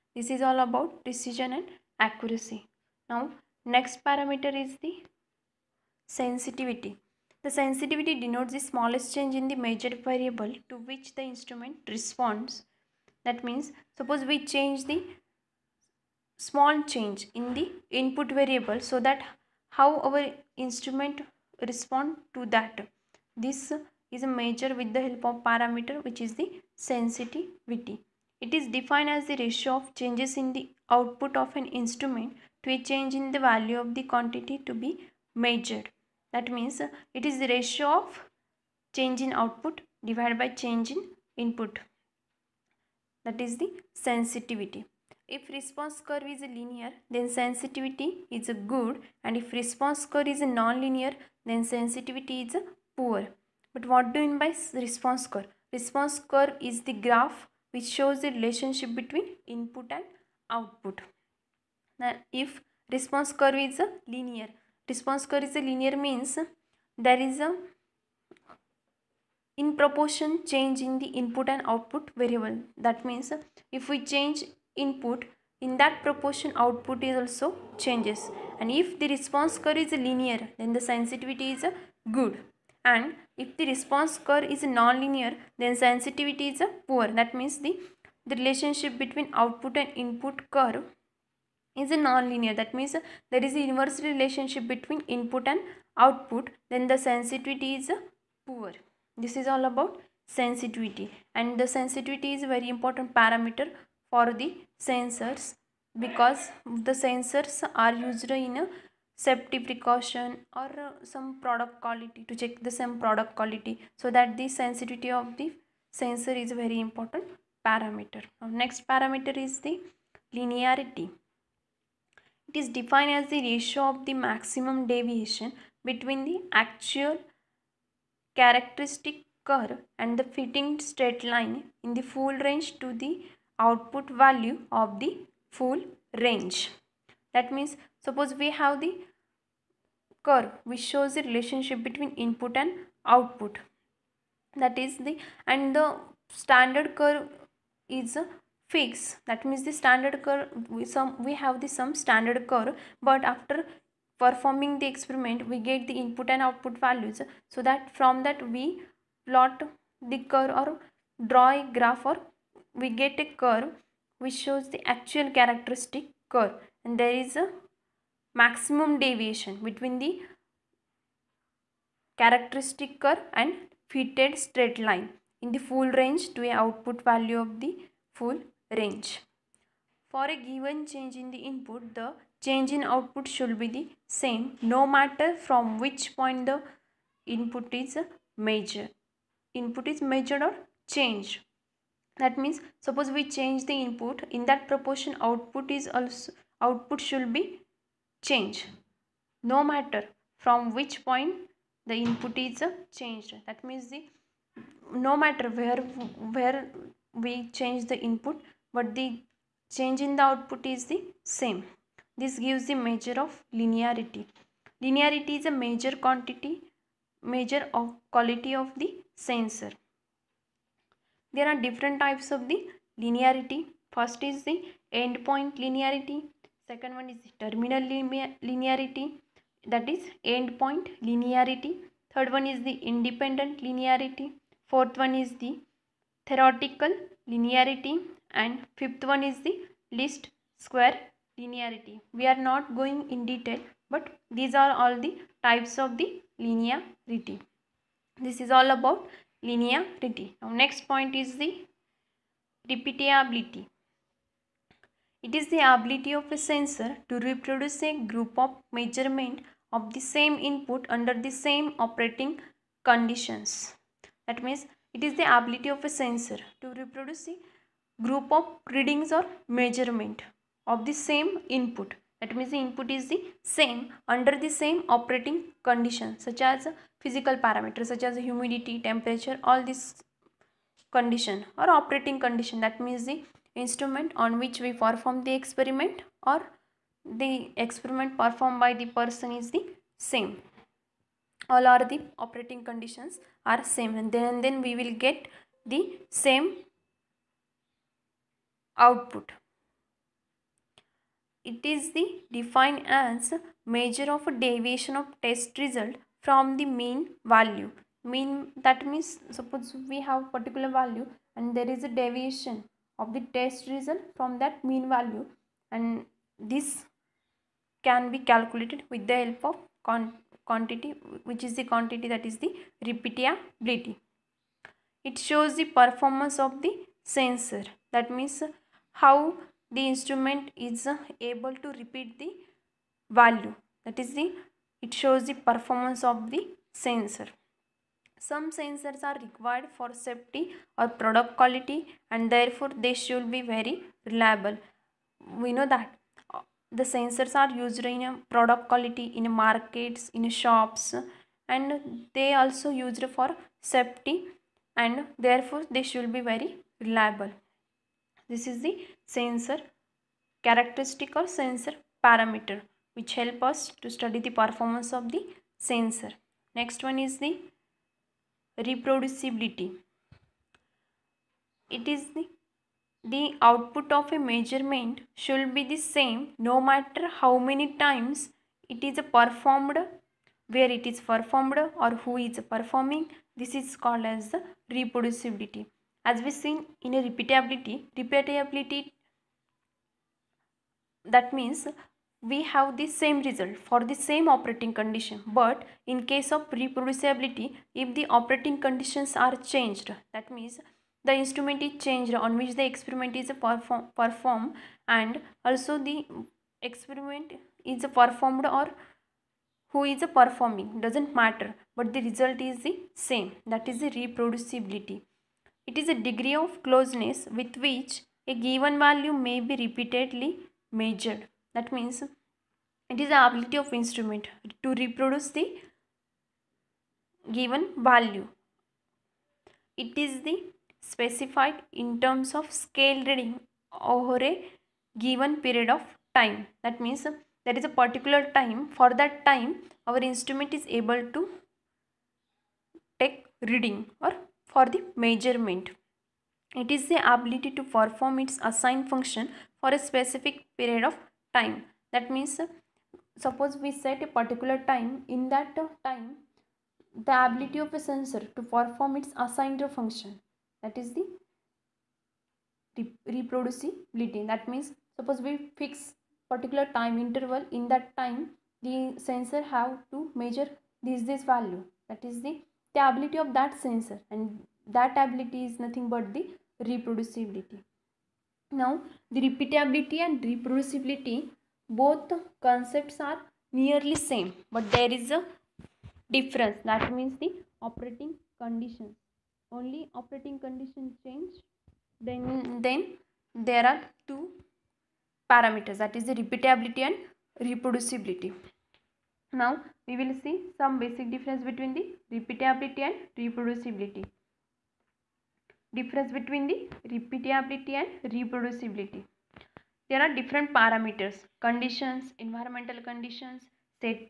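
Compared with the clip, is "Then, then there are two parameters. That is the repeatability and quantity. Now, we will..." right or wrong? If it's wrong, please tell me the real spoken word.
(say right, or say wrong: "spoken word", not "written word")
wrong: "reproducibility", not "quantity".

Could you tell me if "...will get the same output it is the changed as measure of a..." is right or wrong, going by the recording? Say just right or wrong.
wrong.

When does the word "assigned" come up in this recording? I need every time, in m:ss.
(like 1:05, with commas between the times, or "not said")
7:28, 7:39.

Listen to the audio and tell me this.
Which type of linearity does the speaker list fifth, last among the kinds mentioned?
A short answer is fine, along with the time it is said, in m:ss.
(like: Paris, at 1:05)
least square linearity, at 3:59.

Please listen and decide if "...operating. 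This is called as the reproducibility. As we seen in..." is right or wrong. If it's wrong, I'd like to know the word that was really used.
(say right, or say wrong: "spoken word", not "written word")
wrong: "performing", not "operating".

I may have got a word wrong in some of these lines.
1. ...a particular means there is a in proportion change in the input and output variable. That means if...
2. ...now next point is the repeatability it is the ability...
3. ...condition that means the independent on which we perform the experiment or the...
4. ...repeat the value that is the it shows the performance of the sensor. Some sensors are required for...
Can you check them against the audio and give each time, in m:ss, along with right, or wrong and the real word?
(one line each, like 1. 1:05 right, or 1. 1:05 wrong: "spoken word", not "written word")
1. 1:05 wrong: "linear", not "particular"
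2. 4:10 right
3. 4:42 wrong: "instrument", not "independent"
4. 5:31 right.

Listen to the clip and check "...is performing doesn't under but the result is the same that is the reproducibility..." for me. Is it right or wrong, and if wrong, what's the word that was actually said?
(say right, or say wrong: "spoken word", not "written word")
wrong: "matter", not "under".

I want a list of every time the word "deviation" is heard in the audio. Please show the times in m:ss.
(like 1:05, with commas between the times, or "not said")
2:04, 2:48, 5:04, 5:11.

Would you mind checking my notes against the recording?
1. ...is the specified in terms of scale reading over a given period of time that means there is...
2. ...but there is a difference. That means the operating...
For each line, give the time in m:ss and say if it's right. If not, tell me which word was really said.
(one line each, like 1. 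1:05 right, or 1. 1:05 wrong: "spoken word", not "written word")
1. 7:10 right
2. 8:04 right.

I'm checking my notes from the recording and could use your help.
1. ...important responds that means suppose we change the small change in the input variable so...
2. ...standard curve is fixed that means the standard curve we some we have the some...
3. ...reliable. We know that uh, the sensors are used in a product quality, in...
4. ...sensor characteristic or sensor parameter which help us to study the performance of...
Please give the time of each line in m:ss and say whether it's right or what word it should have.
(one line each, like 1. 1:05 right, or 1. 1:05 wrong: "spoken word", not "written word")
1. 0:11 wrong: "instrument", not "important"
2. 2:26 right
3. 5:44 right
4. 5:59 right.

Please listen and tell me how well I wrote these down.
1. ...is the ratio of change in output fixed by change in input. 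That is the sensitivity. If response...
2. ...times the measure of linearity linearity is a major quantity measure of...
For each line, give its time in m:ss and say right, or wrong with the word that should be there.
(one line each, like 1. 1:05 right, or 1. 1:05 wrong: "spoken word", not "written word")
1. 0:37 wrong: "divided", not "fixed"
2. 3:32 wrong: "gives", not "times".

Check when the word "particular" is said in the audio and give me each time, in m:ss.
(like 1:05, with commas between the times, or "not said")
5:10, 7:17, 7:34, 7:46.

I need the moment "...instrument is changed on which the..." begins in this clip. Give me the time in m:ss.
6:41.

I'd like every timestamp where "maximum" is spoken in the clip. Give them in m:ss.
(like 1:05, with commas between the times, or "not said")
2:04, 2:48.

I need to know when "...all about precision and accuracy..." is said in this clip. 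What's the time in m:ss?
0:00.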